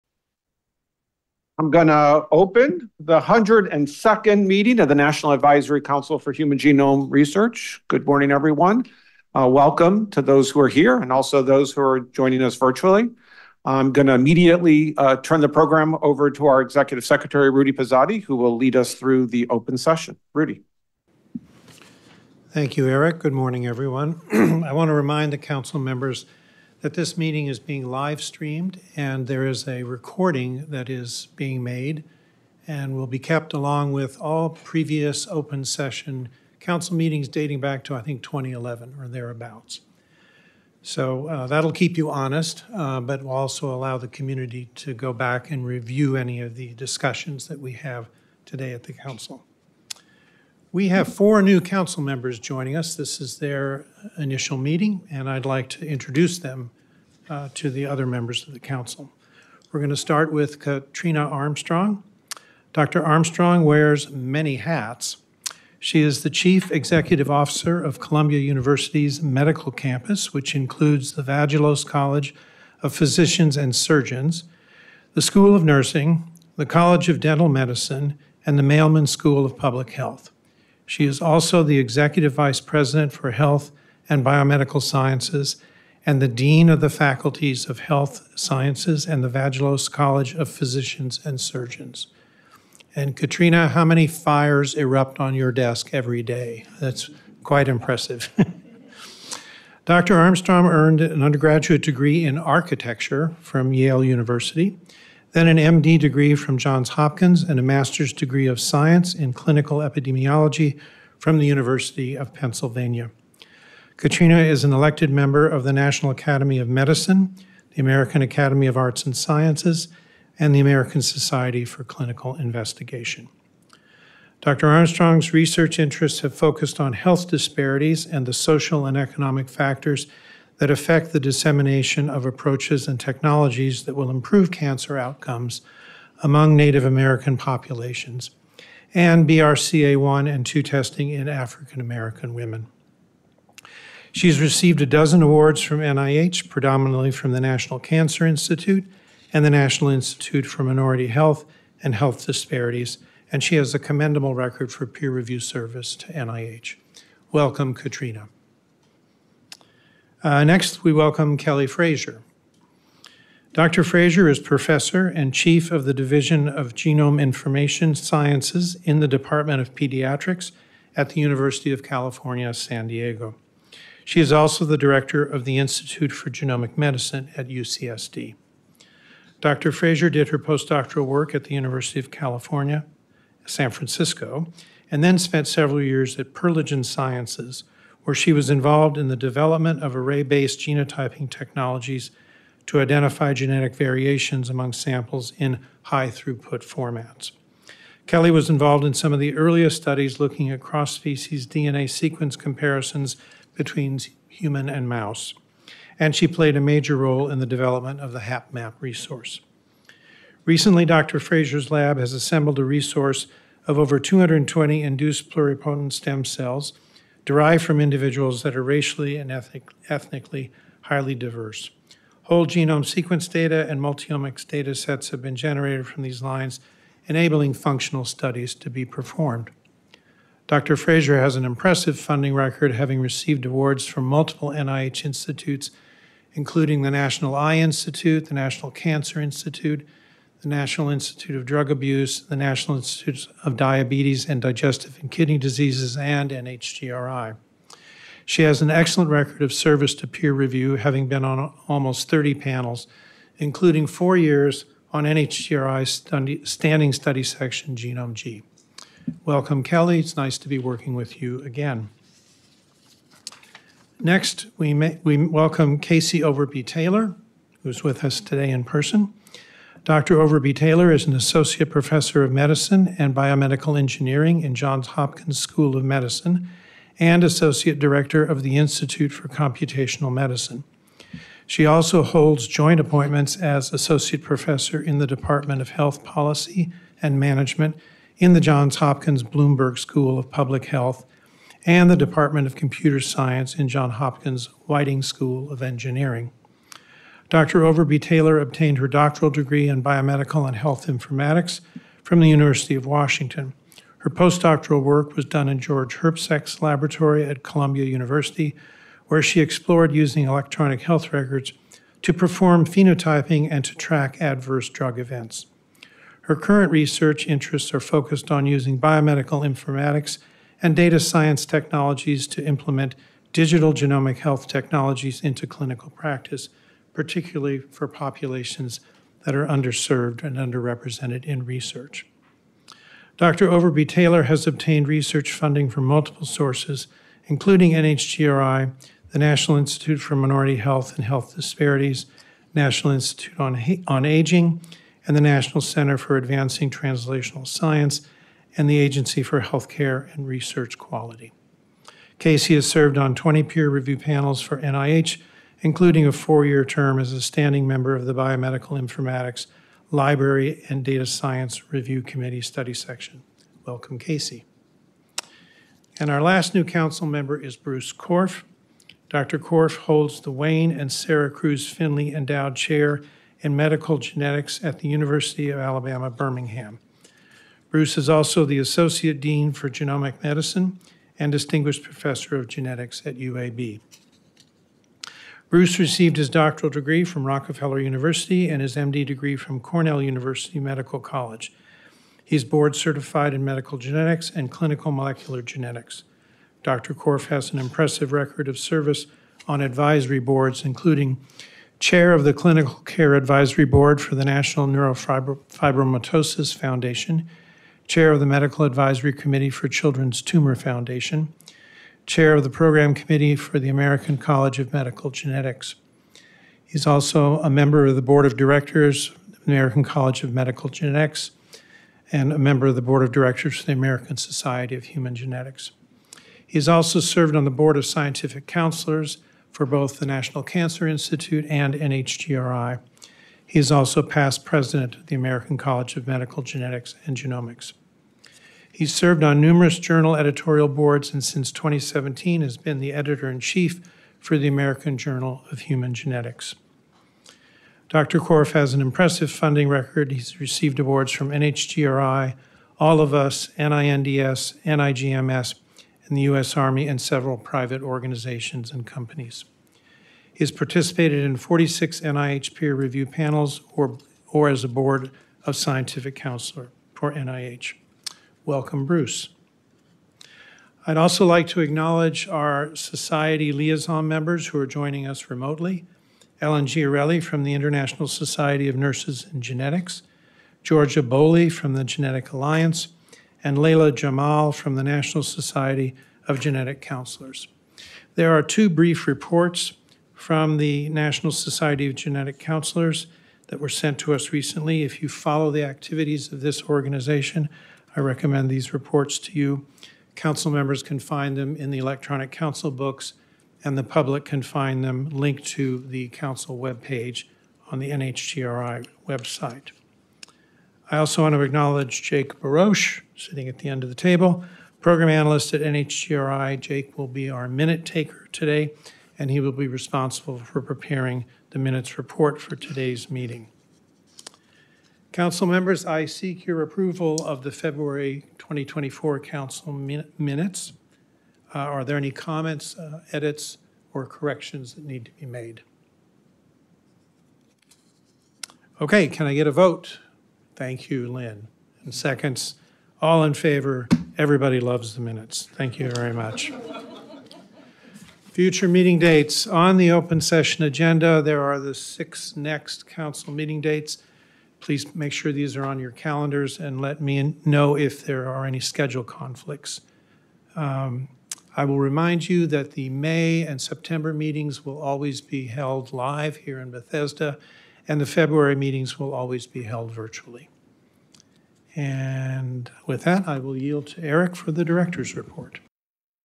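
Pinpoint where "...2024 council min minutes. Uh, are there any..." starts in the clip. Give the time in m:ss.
8:48.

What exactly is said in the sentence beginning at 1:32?
And Katrina, how many fires erupt on your desk every day?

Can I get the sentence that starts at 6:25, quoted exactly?
Bruce received his doctoral degree from Rockefeller University and his MD degree from Cornell University Medical College.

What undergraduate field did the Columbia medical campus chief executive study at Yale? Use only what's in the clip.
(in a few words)
Architecture.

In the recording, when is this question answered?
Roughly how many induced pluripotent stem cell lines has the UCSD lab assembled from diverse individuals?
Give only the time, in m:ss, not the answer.
3:33.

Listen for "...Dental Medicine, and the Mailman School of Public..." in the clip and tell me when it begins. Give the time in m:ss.
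1:17.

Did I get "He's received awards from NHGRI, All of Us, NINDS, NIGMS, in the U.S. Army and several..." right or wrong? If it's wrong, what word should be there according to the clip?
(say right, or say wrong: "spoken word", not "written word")
right.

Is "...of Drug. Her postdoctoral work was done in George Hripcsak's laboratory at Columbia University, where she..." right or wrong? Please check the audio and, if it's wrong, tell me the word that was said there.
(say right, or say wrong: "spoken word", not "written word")
wrong: "Washington", not "Drug".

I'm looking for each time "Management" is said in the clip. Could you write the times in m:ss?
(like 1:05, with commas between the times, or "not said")
4:47.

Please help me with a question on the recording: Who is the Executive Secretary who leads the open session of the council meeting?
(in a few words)
Rudy Pizzotti.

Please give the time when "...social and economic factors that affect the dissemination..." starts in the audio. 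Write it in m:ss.
2:08.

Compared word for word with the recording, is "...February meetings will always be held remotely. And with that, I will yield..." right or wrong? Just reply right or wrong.
wrong.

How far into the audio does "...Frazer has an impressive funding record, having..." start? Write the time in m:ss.
3:50.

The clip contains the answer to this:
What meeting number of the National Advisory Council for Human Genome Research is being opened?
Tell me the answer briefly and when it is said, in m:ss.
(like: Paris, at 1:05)
102nd, at 0:03.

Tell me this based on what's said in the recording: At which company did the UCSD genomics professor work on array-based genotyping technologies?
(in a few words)
Perlegen Sciences.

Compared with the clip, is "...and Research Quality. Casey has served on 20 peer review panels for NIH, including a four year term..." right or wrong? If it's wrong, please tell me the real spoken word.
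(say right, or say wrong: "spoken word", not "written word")
right.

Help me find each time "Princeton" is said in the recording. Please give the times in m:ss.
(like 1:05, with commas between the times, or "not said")
not said.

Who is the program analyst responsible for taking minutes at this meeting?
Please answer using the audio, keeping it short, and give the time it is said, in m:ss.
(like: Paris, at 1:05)
Jake Baroche, at 8:32.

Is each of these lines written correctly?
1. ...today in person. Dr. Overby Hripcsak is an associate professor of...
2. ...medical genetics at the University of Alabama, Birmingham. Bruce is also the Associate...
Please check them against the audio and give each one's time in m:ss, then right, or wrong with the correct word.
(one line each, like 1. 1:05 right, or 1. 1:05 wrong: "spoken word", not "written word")
1. 4:28 wrong: "Taylor", not "Hripcsak"
2. 6:13 right.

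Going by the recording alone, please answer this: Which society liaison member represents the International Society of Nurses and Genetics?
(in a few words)
Ellen Giarelli.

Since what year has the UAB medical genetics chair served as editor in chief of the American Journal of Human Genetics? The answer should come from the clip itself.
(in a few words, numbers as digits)
2017.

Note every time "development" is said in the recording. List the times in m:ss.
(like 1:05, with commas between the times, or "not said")
3:09, 3:27.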